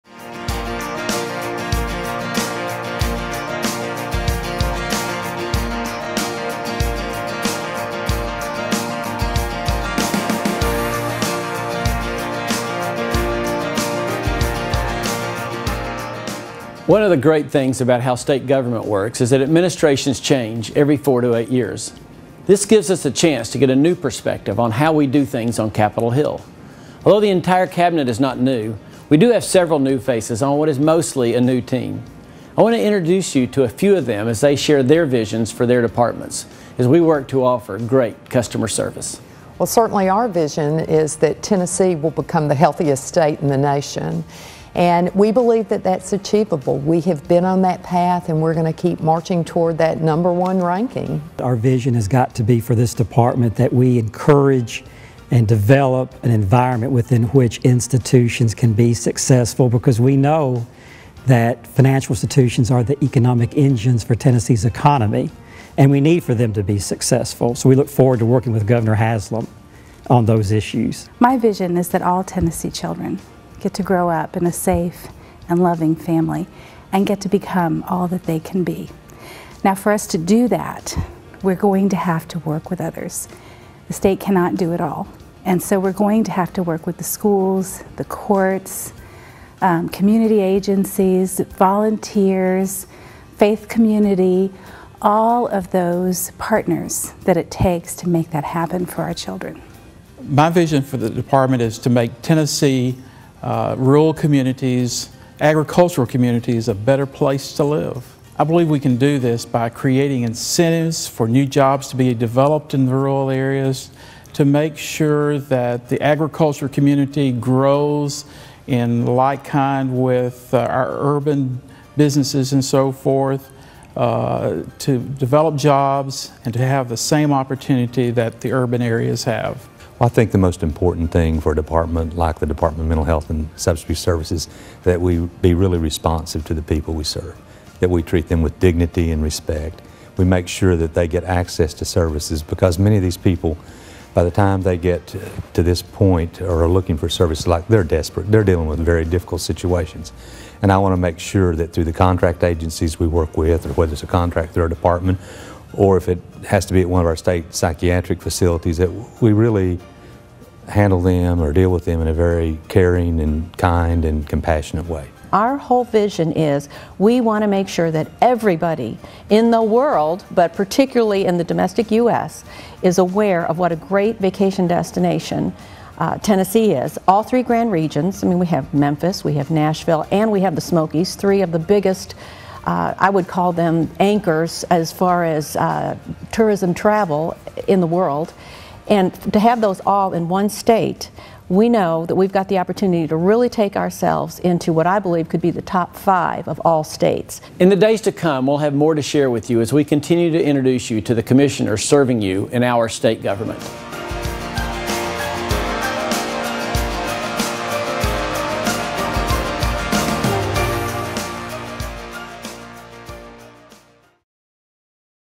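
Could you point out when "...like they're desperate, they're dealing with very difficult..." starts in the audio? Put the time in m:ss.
2:27.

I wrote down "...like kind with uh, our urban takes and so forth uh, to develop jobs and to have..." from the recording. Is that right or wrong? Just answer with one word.
wrong.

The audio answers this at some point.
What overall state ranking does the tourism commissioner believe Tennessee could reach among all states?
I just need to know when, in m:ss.
3:15.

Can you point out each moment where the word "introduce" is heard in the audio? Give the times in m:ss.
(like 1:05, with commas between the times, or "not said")
0:32, 3:20.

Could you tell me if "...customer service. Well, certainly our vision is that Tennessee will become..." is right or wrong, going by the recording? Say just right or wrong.
right.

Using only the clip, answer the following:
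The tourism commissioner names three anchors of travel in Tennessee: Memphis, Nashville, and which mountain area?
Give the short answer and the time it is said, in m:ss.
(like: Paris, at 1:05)
the Smokies, at 3:00.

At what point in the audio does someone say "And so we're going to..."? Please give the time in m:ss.
1:25.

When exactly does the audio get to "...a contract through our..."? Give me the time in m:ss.
2:34.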